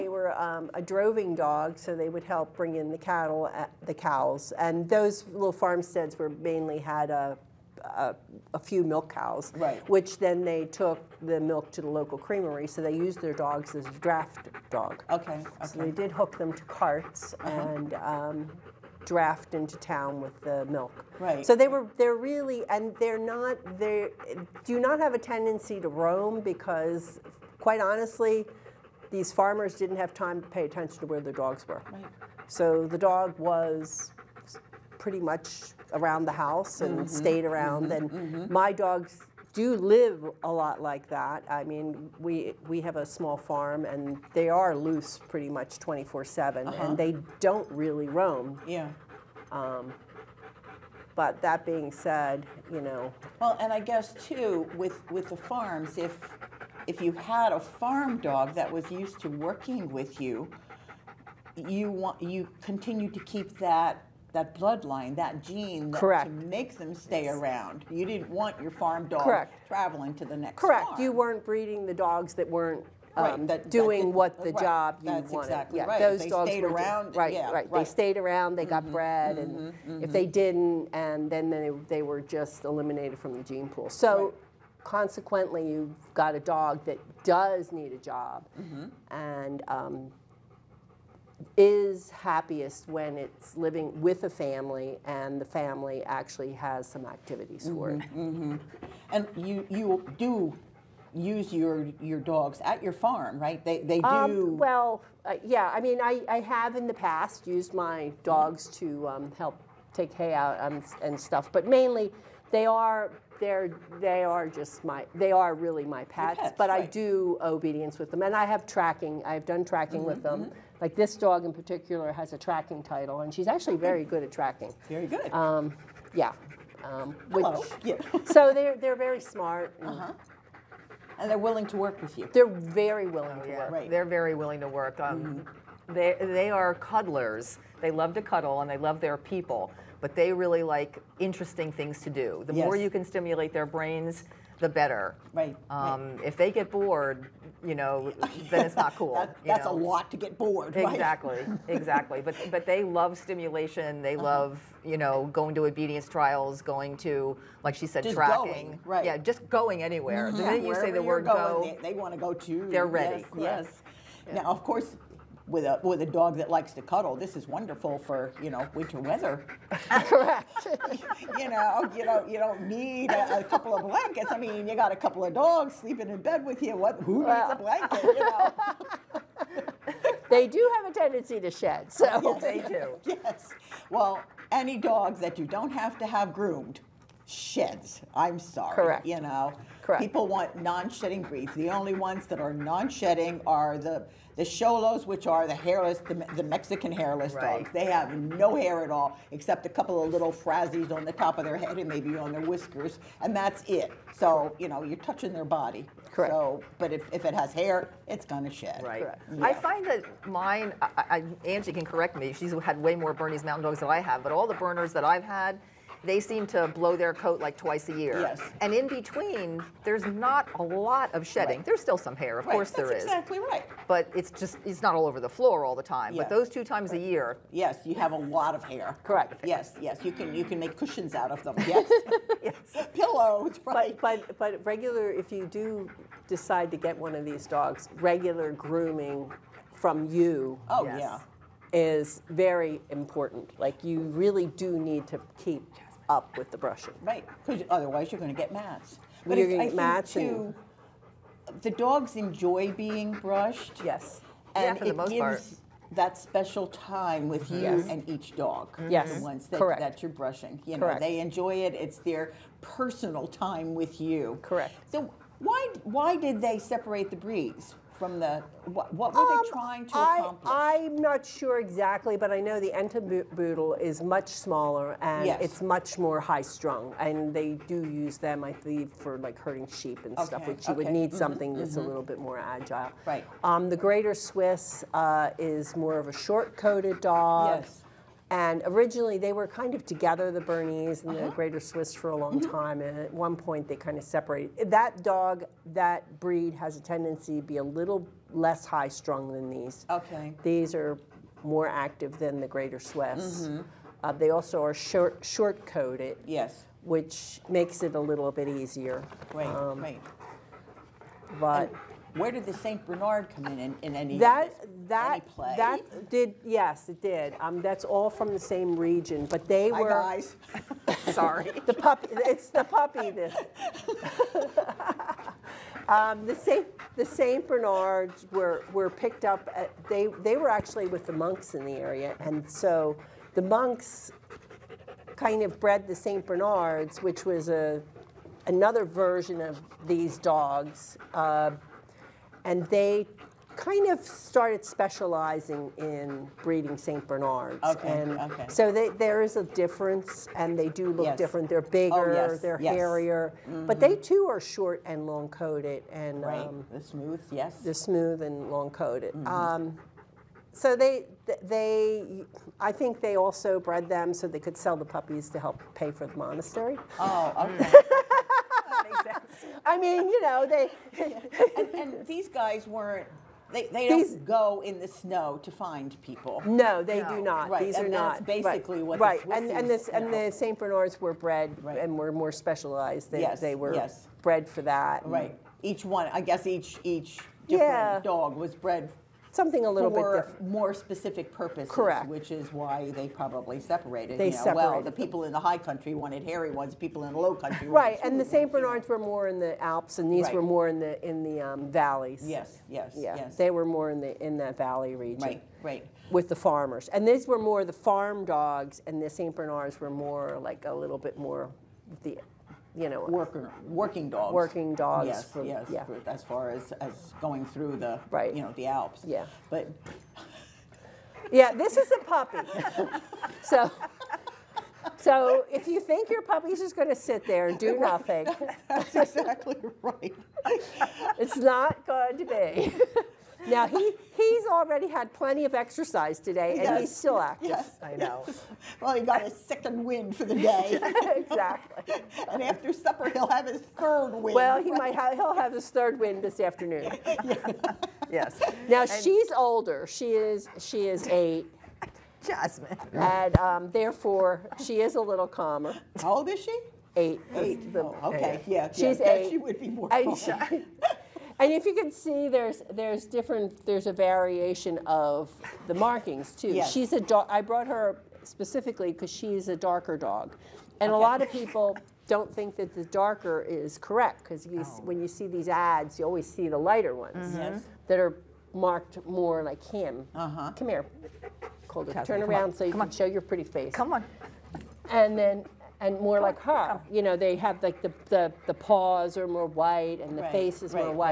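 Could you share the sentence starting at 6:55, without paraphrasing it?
for, as far as as going through the right.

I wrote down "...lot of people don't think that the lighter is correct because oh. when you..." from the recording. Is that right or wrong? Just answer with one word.
wrong.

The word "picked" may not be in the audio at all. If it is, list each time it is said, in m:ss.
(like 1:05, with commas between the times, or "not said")
5:28.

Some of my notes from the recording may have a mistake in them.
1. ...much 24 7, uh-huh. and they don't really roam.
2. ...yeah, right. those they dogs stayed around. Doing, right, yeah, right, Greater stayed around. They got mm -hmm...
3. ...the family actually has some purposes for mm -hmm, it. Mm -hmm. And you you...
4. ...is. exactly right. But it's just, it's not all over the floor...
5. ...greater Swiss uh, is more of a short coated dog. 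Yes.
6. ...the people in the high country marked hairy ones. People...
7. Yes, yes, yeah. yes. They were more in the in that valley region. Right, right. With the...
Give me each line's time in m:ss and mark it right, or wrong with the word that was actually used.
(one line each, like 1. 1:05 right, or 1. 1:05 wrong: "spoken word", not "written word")
1. 0:45 right
2. 1:15 wrong: "They", not "Greater"
3. 1:35 wrong: "activities", not "purposes"
4. 3:42 right
5. 4:43 right
6. 6:34 wrong: "wanted", not "marked"
7. 6:42 right.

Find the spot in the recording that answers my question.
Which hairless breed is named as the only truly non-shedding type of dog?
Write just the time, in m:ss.
3:14.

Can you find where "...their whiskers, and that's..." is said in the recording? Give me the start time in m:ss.
3:22.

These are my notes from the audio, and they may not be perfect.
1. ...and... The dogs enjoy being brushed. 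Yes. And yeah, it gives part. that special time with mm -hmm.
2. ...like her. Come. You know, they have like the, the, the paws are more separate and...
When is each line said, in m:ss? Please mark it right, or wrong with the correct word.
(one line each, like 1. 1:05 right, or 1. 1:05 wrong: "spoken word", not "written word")
1. 4:11 right
2. 8:06 wrong: "white", not "separate".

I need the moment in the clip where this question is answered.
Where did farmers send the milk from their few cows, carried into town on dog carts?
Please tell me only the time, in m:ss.
0:11.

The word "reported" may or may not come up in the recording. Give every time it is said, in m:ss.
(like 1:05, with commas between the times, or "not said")
not said.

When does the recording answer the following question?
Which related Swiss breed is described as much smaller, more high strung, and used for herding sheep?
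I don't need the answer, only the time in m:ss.
4:32.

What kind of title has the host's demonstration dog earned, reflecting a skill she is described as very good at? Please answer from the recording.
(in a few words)
Tracking title.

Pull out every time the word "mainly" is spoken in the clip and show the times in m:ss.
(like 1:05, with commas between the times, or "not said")
0:06, 1:51.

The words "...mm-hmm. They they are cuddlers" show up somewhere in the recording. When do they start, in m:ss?
2:15.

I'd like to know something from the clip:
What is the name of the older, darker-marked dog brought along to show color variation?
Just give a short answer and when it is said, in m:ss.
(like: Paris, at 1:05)
Jasmine, at 7:32.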